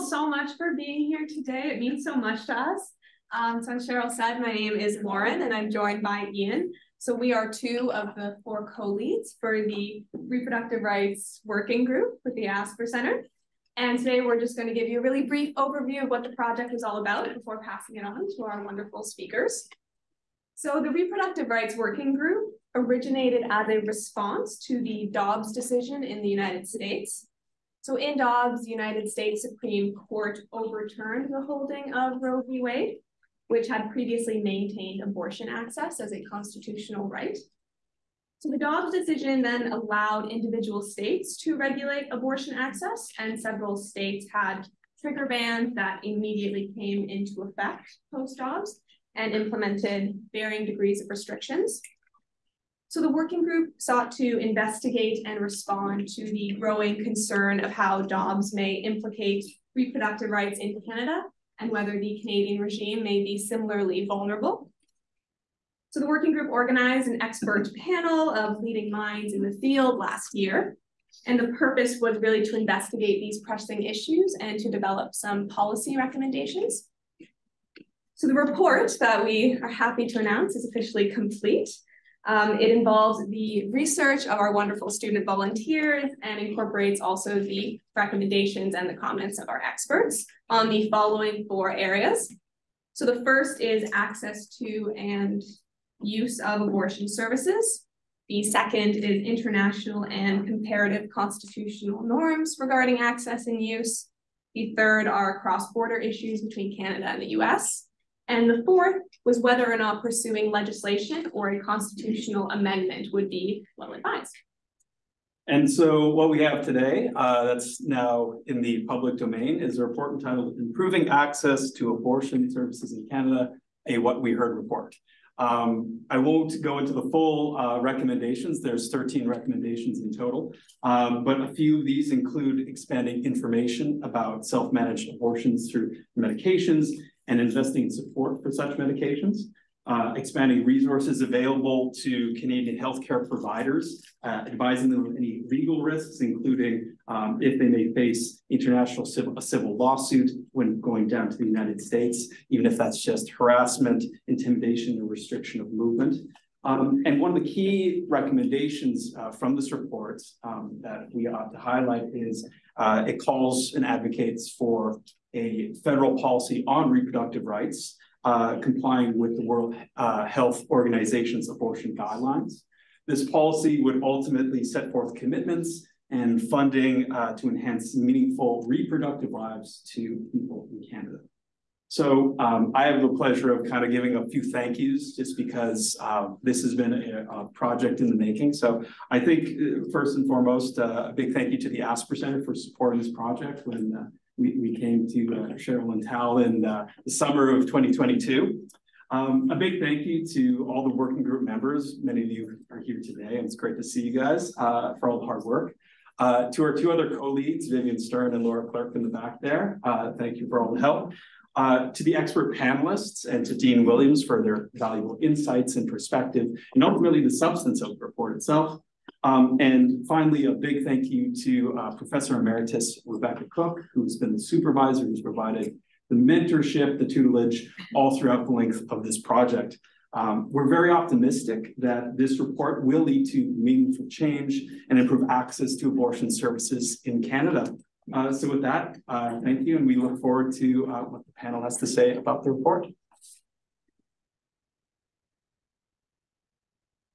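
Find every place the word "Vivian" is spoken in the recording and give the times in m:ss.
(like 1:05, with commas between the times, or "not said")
3:27.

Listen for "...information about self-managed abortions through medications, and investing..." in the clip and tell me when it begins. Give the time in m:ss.
2:13.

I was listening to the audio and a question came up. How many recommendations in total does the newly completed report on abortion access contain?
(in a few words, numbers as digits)
13.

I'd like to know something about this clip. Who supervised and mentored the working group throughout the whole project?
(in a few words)
Rebecca Cook.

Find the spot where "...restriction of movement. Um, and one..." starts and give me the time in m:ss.
2:35.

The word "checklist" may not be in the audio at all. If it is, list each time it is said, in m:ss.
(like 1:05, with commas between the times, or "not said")
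not said.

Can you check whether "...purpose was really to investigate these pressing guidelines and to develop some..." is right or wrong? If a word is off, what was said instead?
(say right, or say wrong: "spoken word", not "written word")
wrong: "issues", not "guidelines".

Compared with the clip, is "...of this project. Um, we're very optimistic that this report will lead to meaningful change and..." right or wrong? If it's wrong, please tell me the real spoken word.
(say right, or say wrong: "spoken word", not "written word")
right.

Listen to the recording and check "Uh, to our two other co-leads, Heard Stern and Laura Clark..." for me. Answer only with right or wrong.
wrong.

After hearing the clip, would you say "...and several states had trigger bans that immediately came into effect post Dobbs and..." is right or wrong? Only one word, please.
right.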